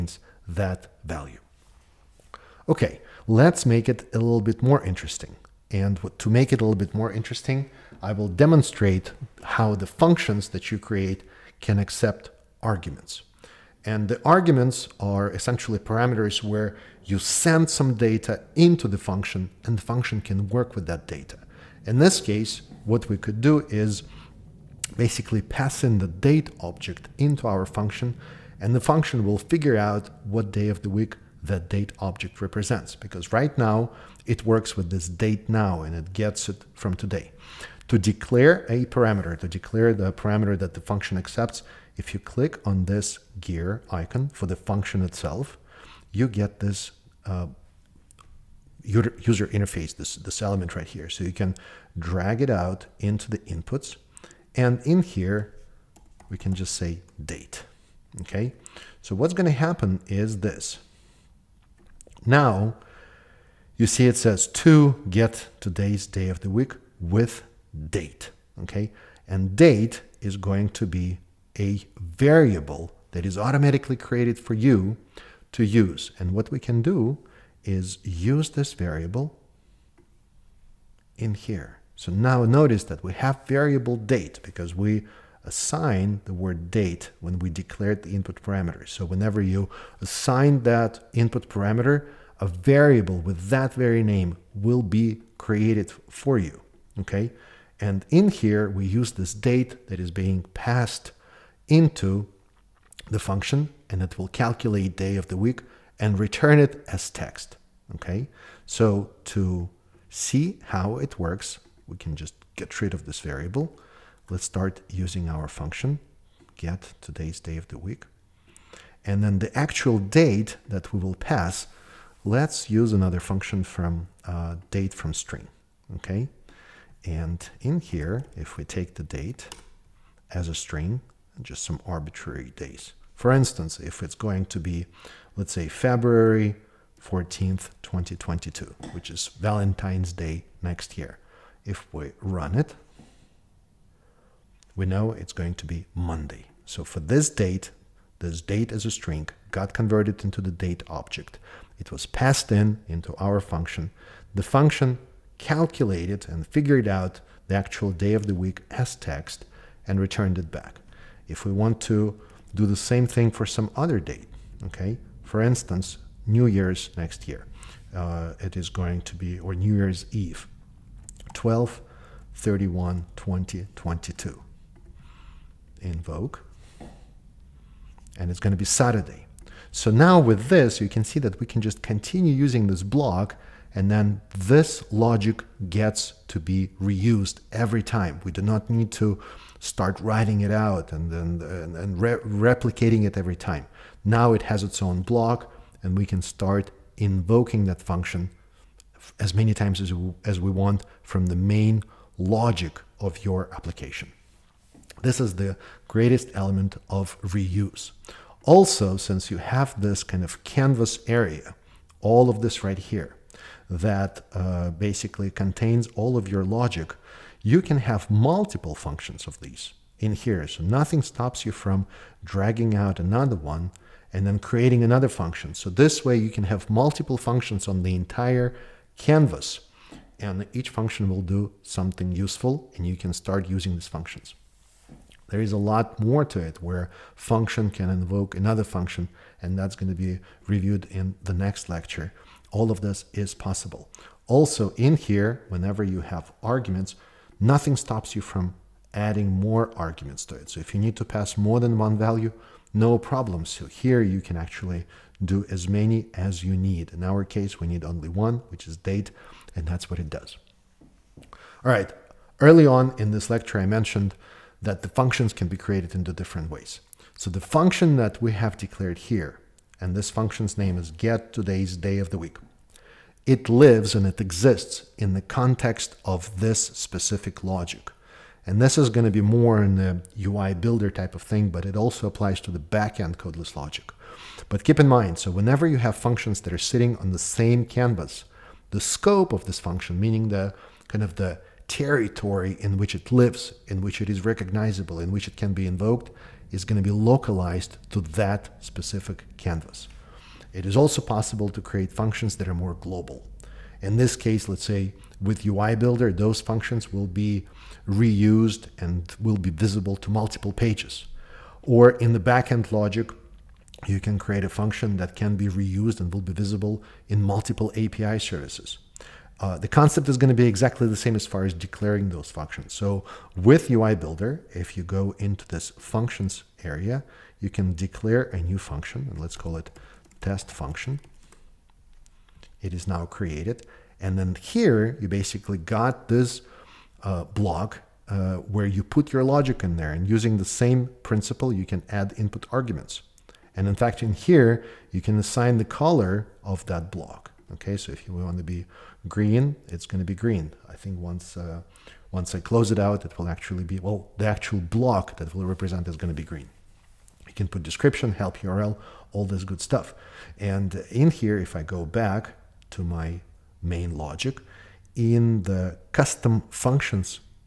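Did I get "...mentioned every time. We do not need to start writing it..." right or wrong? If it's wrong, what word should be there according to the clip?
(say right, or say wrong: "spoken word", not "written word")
wrong: "reused", not "mentioned".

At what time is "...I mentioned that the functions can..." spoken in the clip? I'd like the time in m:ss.
4:23.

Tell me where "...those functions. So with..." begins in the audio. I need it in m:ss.
5:22.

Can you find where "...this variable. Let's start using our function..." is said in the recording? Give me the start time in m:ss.
1:53.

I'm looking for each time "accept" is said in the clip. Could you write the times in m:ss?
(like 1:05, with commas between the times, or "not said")
0:11, 0:41.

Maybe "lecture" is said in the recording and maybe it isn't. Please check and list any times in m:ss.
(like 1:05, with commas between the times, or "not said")
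4:01, 4:23.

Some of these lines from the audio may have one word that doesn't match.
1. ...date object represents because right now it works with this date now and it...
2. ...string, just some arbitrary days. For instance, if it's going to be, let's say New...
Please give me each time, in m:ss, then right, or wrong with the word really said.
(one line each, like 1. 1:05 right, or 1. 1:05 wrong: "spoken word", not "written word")
1. 0:31 right
2. 2:10 wrong: "February", not "New".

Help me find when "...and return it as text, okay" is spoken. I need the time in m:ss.
1:45.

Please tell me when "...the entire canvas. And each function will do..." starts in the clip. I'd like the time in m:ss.
3:47.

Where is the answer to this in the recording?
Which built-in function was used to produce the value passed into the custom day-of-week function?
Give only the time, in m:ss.
2:04.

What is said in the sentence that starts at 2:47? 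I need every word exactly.
Uh, it is going to be, or New Year's Eve.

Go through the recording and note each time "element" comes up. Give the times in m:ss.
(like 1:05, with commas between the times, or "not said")
0:50, 3:26.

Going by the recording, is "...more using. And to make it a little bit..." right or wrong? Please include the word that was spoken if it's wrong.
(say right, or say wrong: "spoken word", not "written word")
wrong: "interesting", not "using".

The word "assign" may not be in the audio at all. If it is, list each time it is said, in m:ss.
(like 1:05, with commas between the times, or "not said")
1:25, 1:30, 5:45.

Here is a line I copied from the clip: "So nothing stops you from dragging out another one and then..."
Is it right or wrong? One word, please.
right.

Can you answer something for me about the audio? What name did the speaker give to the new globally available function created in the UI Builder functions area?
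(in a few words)
test function.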